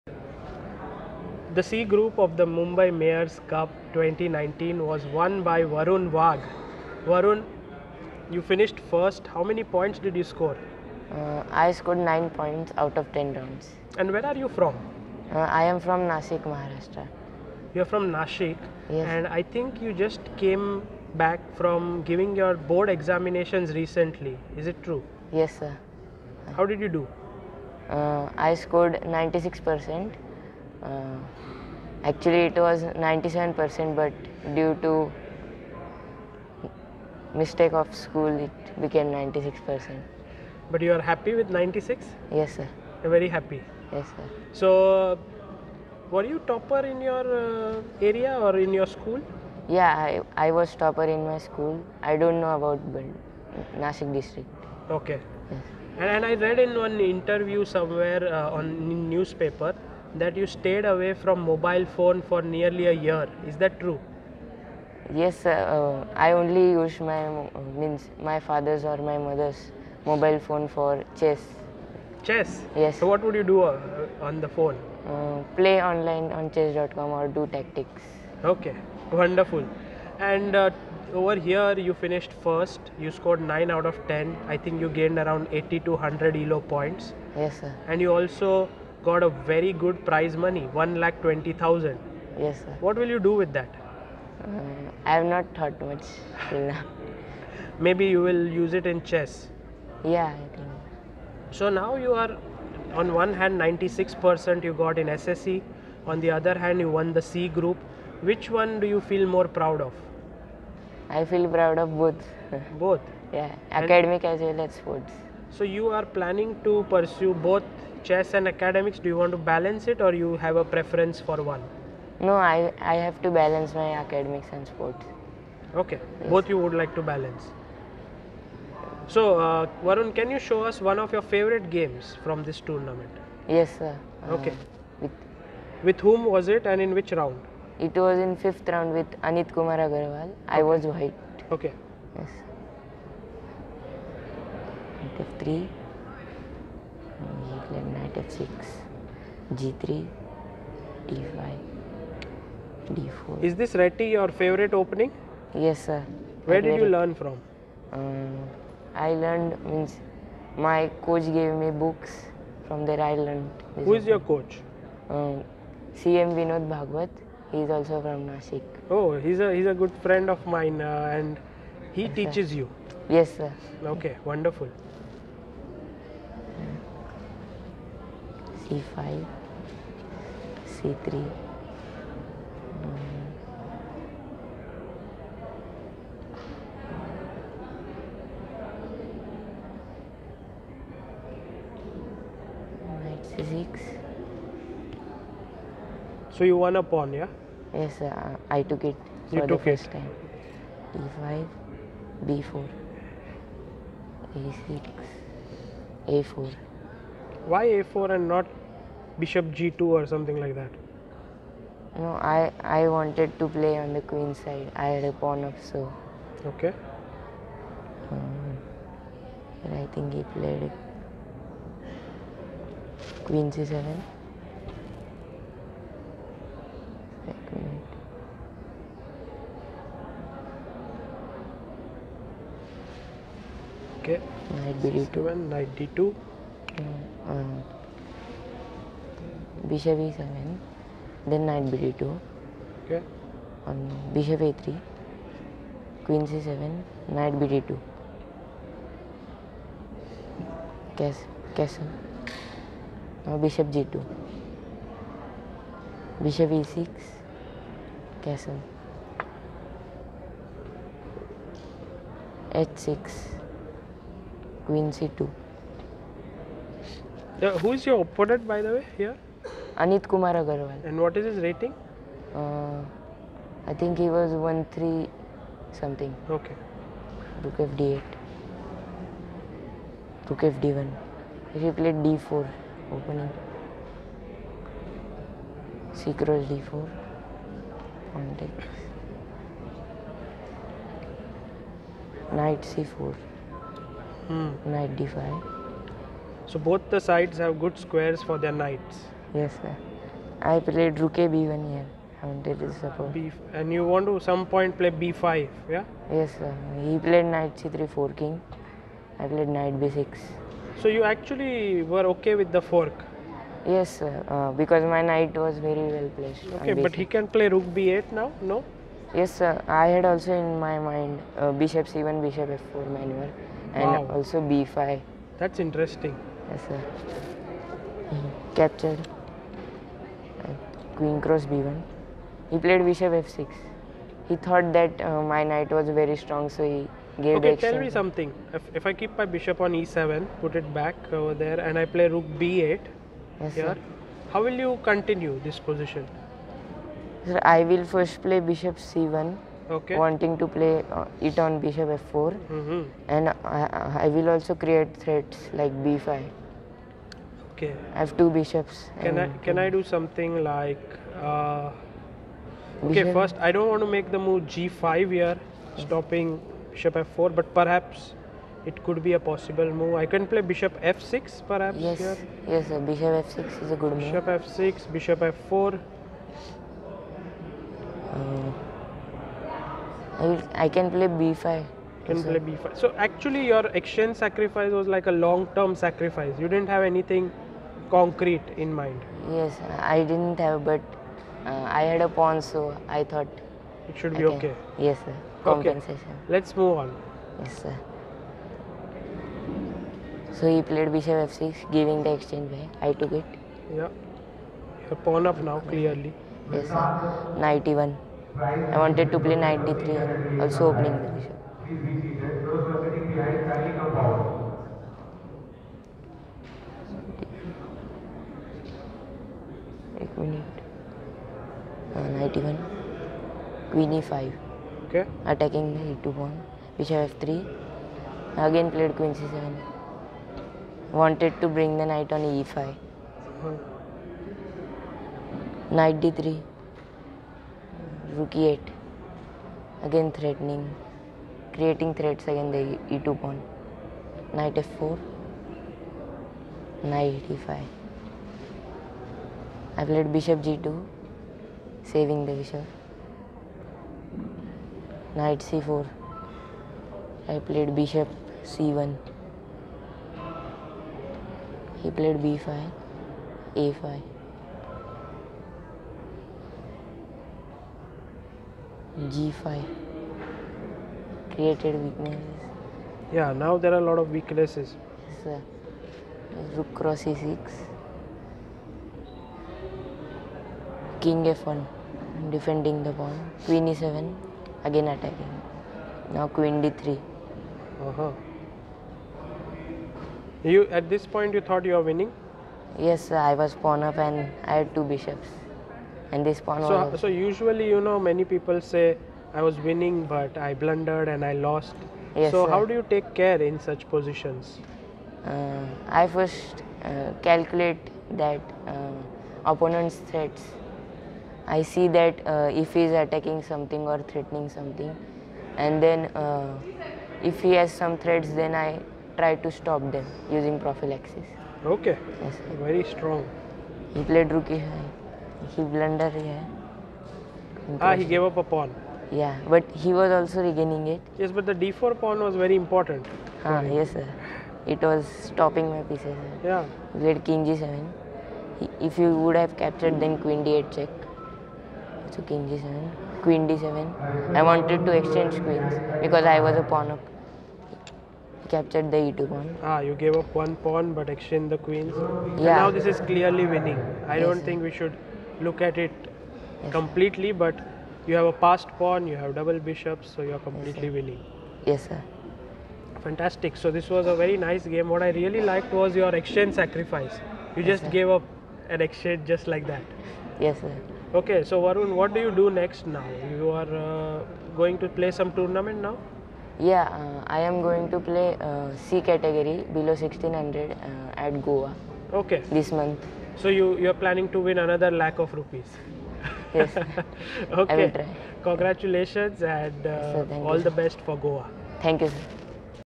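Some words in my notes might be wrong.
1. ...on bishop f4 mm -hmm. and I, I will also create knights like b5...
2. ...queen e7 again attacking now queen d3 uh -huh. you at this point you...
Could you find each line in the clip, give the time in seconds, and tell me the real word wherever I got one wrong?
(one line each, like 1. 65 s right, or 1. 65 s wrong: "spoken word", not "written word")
1. 351 s wrong: "threats", not "knights"
2. 483 s right.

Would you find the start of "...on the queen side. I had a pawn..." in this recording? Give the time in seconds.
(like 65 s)
213 s.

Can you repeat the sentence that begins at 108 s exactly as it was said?
Which one do you feel more proud of?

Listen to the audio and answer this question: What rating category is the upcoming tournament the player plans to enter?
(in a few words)
Below 1600.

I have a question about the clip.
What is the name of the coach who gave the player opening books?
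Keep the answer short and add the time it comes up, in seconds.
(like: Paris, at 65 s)
CM Vinod Bhagwat, at 166 s.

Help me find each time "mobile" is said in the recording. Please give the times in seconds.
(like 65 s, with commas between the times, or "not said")
61 s, 70 s.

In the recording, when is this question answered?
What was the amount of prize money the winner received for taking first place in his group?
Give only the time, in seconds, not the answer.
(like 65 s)
90 s.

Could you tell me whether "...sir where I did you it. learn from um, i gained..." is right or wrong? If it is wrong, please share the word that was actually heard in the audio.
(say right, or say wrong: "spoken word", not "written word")
wrong: "learned", not "gained".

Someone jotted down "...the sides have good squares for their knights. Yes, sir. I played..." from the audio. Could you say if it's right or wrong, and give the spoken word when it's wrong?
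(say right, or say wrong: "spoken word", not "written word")
right.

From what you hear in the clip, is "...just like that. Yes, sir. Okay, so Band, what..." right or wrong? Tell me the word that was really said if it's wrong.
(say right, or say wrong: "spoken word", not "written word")
wrong: "Varun", not "Band".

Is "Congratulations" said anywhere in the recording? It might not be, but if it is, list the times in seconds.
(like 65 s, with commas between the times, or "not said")
588 s.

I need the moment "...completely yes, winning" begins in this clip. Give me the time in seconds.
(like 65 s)
560 s.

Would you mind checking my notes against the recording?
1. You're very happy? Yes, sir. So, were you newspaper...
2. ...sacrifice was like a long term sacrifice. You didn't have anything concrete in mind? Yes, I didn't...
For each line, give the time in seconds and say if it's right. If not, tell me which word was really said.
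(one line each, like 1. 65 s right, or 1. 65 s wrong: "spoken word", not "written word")
1. 43 s wrong: "topper", not "newspaper"
2. 384 s right.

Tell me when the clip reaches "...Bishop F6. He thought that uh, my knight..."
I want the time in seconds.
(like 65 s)
332 s.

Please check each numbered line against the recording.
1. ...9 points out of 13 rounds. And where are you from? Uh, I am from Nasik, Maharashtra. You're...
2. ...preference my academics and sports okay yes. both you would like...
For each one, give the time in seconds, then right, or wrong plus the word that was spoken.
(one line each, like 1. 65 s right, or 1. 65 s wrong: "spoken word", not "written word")
1. 11 s wrong: "10", not "13"
2. 123 s wrong: "balance", not "preference".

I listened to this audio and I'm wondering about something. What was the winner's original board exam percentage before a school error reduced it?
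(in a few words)
97%.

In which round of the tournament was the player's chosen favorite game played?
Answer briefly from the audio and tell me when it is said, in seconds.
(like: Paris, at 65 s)
Fifth round, at 138 s.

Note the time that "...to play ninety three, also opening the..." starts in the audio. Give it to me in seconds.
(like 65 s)
409 s.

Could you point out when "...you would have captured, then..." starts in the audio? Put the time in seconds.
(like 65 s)
538 s.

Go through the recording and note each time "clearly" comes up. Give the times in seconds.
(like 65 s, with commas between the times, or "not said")
405 s, 553 s.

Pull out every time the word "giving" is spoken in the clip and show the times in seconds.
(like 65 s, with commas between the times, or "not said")
22 s, 401 s.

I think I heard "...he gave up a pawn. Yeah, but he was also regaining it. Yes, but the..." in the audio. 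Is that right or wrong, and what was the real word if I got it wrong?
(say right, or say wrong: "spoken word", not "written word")
right.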